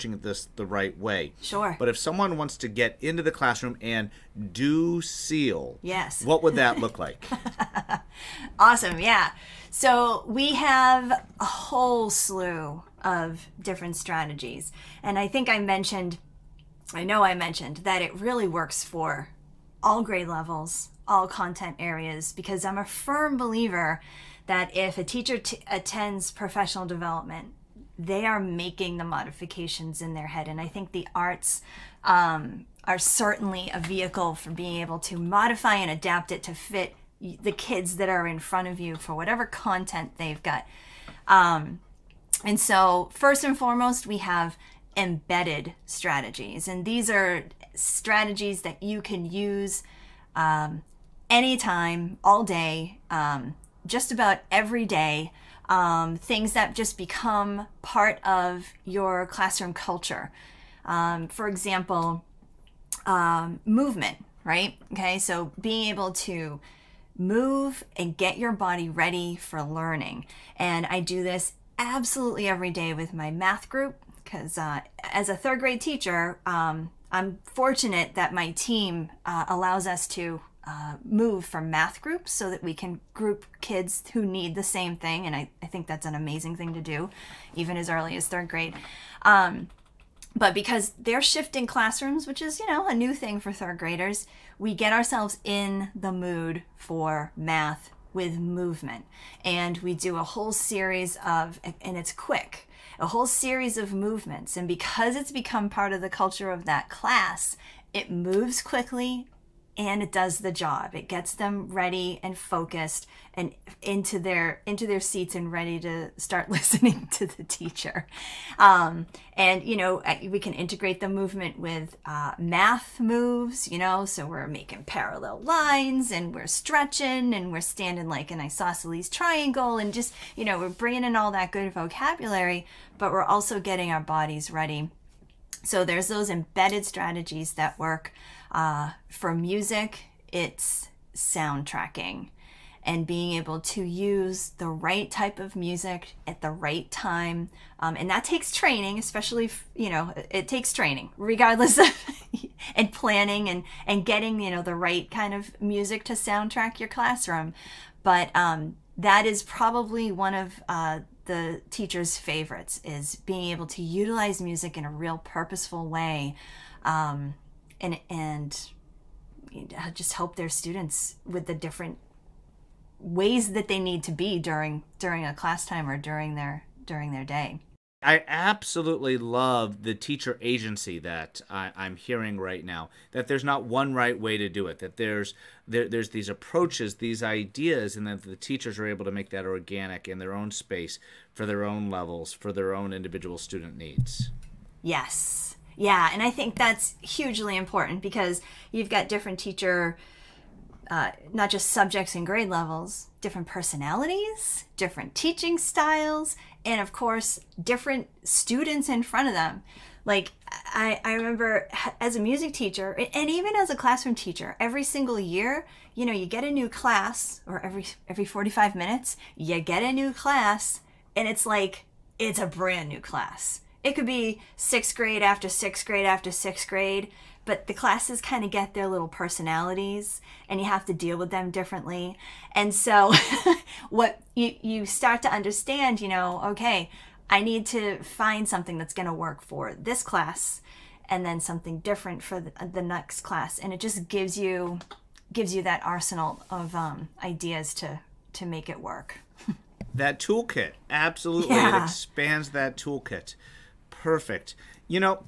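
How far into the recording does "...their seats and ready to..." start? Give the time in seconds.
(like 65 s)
114 s.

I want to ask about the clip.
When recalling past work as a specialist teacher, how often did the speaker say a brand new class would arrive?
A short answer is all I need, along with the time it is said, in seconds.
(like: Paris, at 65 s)
Every 45 minutes, at 218 s.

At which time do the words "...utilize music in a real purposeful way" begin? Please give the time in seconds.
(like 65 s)
163 s.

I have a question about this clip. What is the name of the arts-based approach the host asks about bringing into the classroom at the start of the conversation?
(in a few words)
SEAL.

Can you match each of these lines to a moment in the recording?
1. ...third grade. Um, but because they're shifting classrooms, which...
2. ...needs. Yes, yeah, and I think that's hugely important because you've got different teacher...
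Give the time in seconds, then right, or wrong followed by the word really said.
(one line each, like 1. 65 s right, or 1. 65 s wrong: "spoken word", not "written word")
1. 88 s right
2. 193 s right.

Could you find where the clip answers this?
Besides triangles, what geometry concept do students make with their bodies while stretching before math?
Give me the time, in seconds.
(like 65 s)
124 s.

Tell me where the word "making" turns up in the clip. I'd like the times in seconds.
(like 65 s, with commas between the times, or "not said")
28 s, 124 s.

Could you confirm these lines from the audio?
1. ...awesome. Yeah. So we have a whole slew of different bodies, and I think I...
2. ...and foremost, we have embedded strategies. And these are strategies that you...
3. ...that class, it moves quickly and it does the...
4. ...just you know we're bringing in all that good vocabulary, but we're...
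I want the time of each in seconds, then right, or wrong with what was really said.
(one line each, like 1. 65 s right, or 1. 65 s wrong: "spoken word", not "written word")
1. 8 s wrong: "strategies", not "bodies"
2. 43 s right
3. 106 s right
4. 129 s right.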